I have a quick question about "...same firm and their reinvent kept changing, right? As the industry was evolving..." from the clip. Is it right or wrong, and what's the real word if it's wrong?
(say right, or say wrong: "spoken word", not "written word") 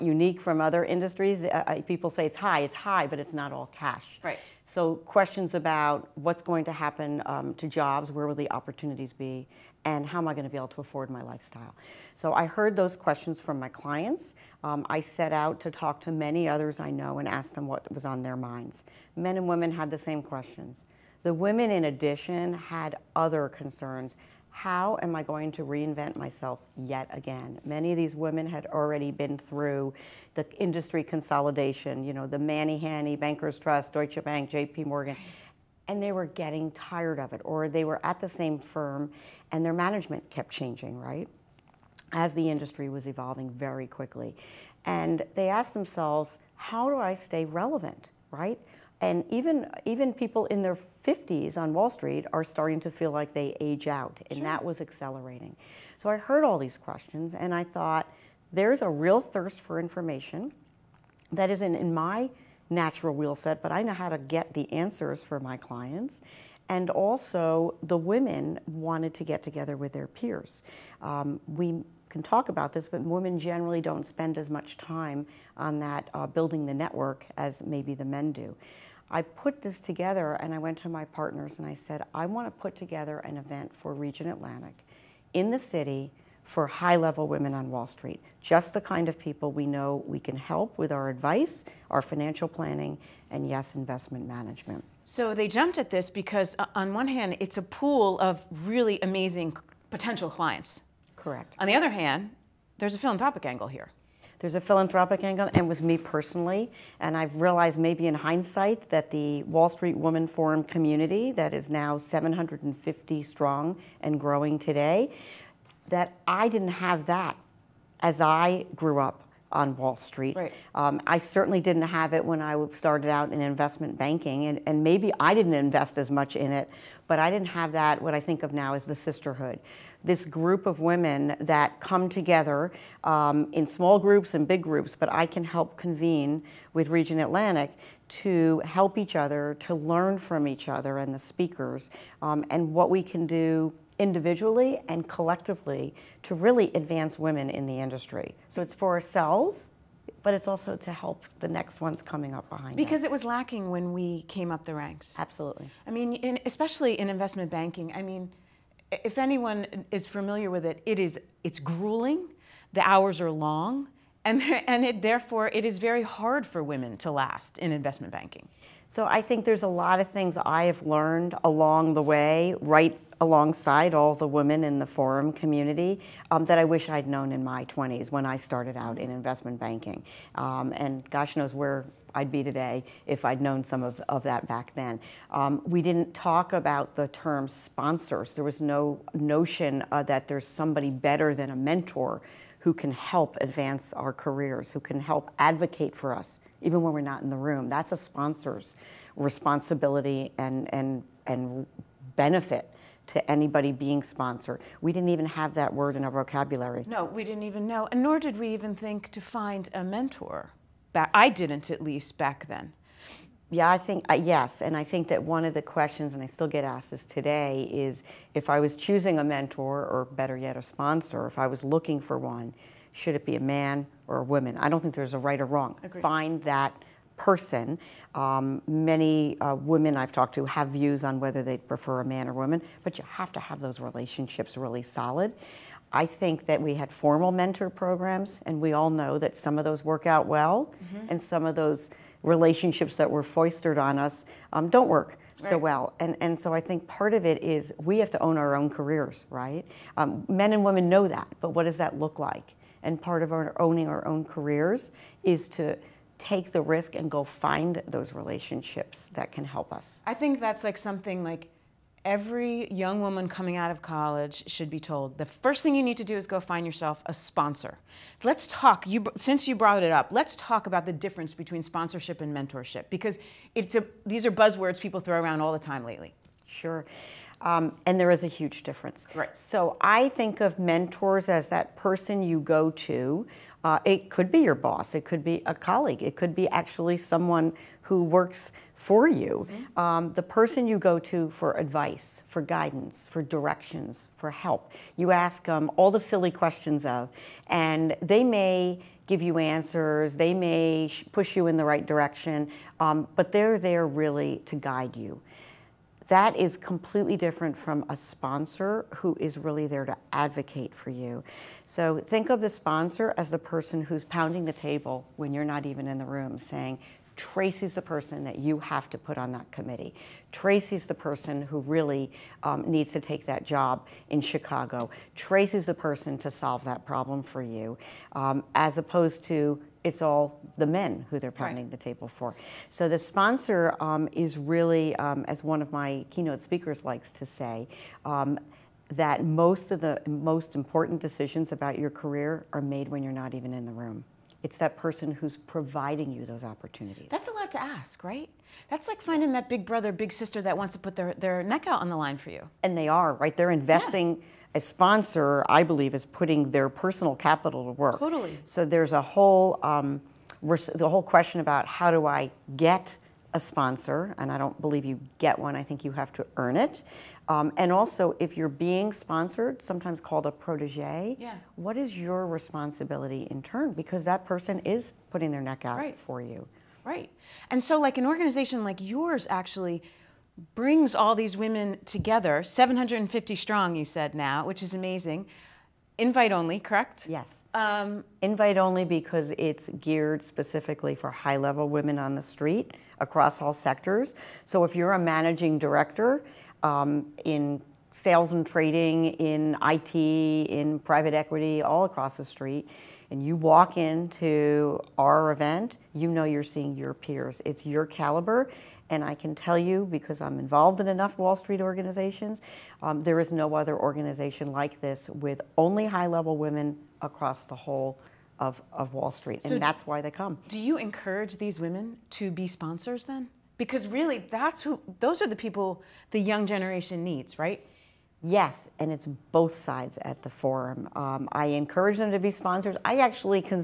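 wrong: "management", not "reinvent".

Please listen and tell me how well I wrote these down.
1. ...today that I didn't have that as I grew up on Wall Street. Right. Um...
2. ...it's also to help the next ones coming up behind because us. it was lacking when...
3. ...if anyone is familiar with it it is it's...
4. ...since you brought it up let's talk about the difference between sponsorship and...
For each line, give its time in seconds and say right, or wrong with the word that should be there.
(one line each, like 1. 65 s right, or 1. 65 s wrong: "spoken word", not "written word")
1. 114 s right
2. 150 s right
3. 158 s right
4. 269 s right.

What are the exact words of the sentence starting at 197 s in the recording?
That's a sponsor's responsibility and, and, and benefit to anybody being sponsored.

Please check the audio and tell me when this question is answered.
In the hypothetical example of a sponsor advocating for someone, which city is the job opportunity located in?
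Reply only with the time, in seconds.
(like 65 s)
324 s.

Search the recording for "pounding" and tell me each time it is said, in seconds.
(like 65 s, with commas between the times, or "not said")
314 s, 331 s.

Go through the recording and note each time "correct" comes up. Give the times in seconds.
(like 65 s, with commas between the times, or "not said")
101 s, 386 s.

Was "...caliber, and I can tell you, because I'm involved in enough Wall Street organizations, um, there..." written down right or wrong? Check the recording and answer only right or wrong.
right.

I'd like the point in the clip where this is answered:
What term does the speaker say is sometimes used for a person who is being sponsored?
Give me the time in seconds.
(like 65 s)
370 s.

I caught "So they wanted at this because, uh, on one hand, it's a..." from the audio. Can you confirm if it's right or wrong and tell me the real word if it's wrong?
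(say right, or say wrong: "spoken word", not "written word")
wrong: "jumped", not "wanted".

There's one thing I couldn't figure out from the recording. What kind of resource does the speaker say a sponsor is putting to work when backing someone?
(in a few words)
personal capital.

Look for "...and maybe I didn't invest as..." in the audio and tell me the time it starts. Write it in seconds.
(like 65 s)
124 s.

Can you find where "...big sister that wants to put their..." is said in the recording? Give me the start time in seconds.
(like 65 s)
349 s.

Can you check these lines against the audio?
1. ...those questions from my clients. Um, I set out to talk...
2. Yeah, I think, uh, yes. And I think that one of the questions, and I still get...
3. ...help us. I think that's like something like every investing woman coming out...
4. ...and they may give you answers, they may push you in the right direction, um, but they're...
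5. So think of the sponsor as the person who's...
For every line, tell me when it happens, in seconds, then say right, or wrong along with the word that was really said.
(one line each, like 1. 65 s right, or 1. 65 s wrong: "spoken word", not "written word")
1. 12 s right
2. 213 s right
3. 259 s wrong: "young", not "investing"
4. 297 s right
5. 311 s right.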